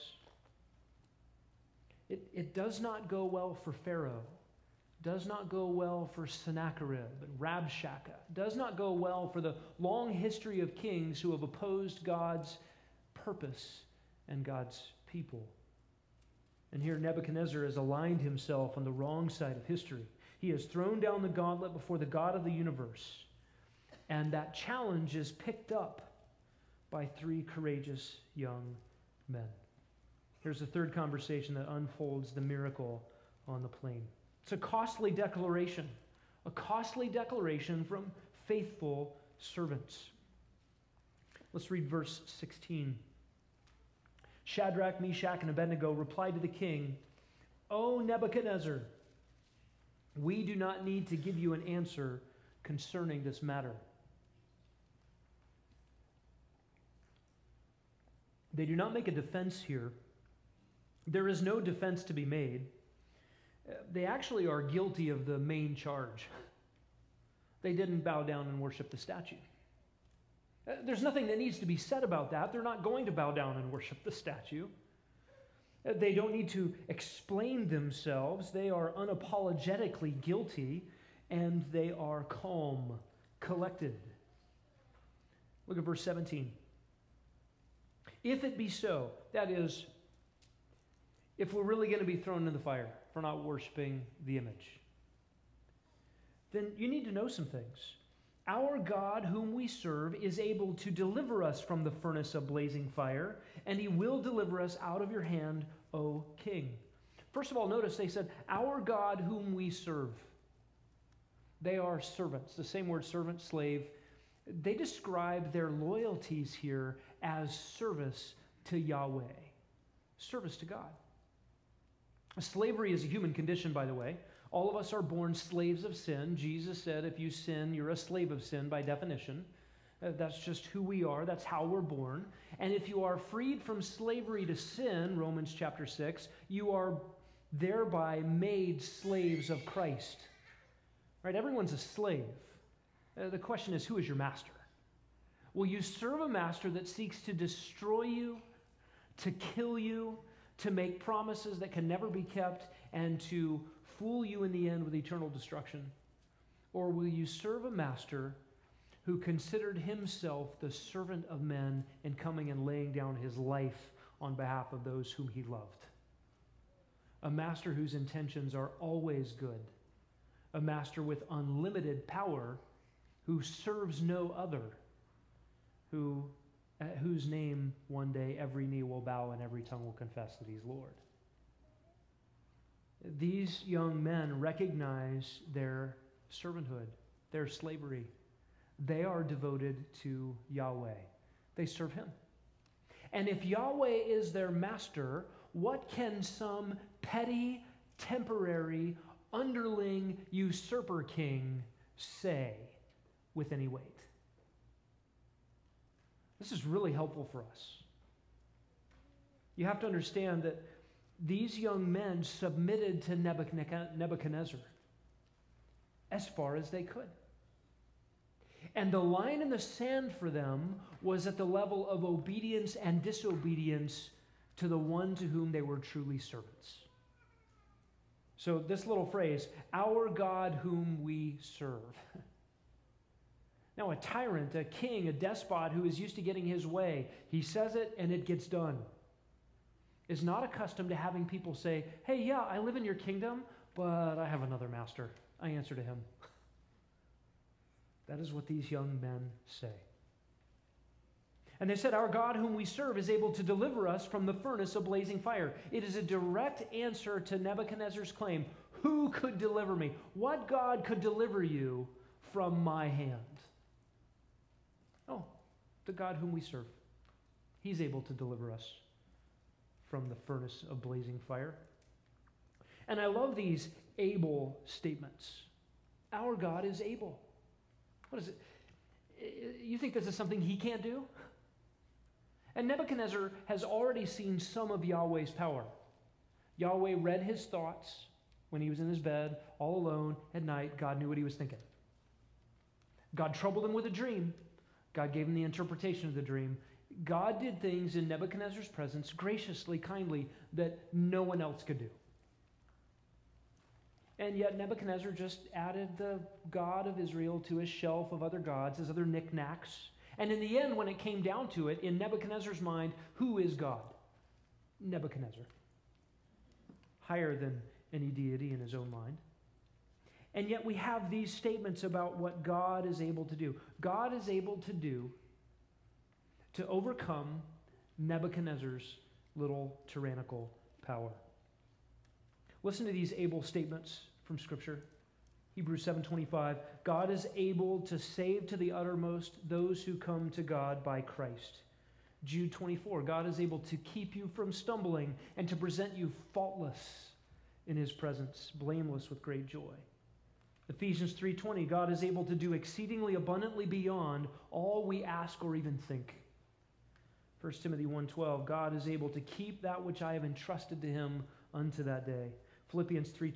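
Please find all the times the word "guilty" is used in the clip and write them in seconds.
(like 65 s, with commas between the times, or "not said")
64 s, 80 s.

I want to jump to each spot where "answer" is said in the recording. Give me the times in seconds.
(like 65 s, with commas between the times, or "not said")
51 s, 245 s, 256 s.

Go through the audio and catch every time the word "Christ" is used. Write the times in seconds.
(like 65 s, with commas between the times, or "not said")
139 s, 340 s.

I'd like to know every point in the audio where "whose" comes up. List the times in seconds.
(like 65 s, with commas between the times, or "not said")
167 s, 177 s.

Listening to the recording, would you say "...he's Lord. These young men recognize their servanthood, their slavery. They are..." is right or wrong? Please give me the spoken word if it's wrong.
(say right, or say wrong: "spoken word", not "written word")
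right.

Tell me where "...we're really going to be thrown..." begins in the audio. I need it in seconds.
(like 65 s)
91 s.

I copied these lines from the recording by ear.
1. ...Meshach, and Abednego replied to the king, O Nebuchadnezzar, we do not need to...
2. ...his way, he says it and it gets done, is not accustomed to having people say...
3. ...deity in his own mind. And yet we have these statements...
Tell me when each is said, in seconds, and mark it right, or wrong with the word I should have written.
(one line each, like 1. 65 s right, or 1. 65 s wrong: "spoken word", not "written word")
1. 44 s right
2. 236 s right
3. 318 s right.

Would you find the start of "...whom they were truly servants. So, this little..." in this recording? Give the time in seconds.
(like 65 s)
225 s.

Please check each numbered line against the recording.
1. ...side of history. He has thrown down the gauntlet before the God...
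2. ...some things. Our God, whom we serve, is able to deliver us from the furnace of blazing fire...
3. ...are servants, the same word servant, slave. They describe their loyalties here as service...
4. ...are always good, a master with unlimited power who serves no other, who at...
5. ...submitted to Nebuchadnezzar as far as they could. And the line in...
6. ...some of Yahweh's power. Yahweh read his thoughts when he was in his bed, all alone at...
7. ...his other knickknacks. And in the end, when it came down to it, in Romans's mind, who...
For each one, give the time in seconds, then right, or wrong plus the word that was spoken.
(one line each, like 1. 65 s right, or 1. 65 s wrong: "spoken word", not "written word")
1. 19 s right
2. 97 s right
3. 111 s right
4. 168 s right
5. 212 s right
6. 284 s right
7. 308 s wrong: "Nebuchadnezzar", not "Romans".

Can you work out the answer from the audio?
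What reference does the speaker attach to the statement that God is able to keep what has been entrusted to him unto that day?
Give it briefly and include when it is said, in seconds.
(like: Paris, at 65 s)
1 Timothy 1:12, at 357 s.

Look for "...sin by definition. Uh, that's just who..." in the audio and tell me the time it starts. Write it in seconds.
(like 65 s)
128 s.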